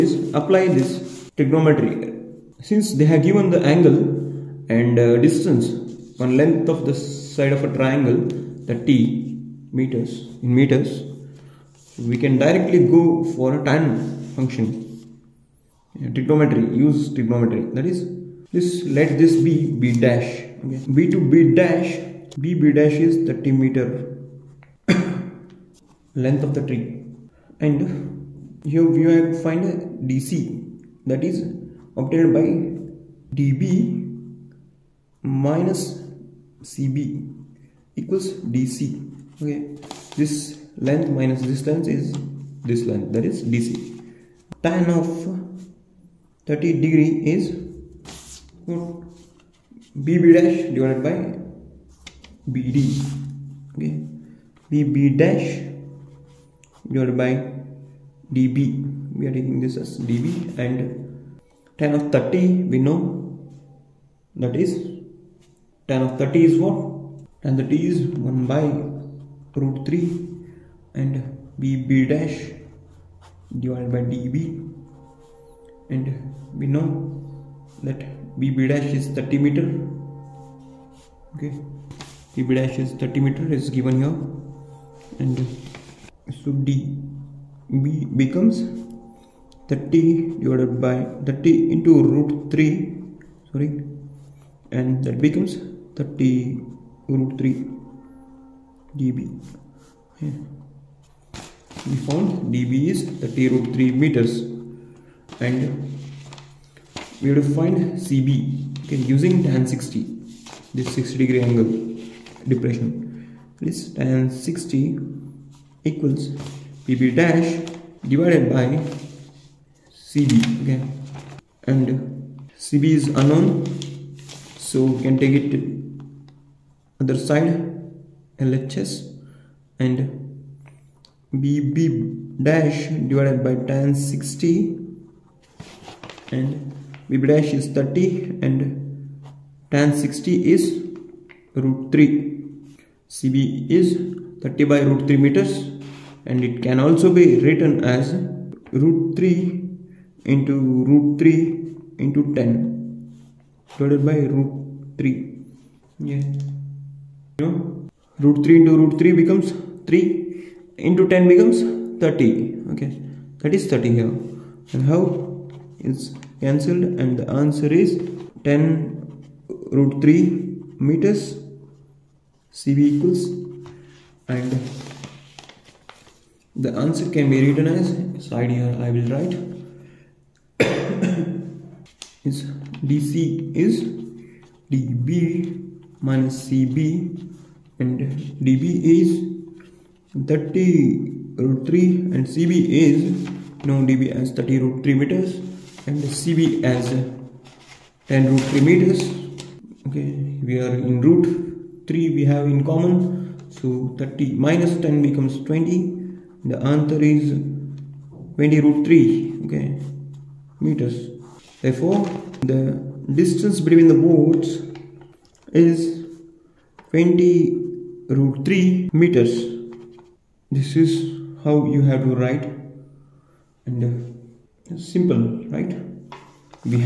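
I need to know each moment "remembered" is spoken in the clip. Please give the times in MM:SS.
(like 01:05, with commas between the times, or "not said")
not said.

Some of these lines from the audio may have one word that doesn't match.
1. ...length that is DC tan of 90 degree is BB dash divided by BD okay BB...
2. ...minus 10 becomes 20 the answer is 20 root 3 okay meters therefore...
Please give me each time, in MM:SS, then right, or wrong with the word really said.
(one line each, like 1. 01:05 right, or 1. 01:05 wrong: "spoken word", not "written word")
1. 00:42 wrong: "30", not "90"
2. 03:24 right.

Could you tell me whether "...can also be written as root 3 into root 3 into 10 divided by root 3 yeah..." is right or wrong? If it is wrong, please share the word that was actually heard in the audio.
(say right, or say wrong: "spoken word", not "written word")
right.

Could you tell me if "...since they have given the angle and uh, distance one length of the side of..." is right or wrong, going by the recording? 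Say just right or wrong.
right.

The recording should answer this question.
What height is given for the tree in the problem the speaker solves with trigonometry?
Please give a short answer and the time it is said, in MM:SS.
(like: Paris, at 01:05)
30 meters, at 00:23.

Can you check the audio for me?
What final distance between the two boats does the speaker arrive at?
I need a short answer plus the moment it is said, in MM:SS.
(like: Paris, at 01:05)
20 root 3 meters, at 03:36.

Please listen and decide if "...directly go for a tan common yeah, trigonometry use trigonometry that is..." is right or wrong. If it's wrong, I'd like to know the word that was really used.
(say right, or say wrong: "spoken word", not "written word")
wrong: "function", not "common".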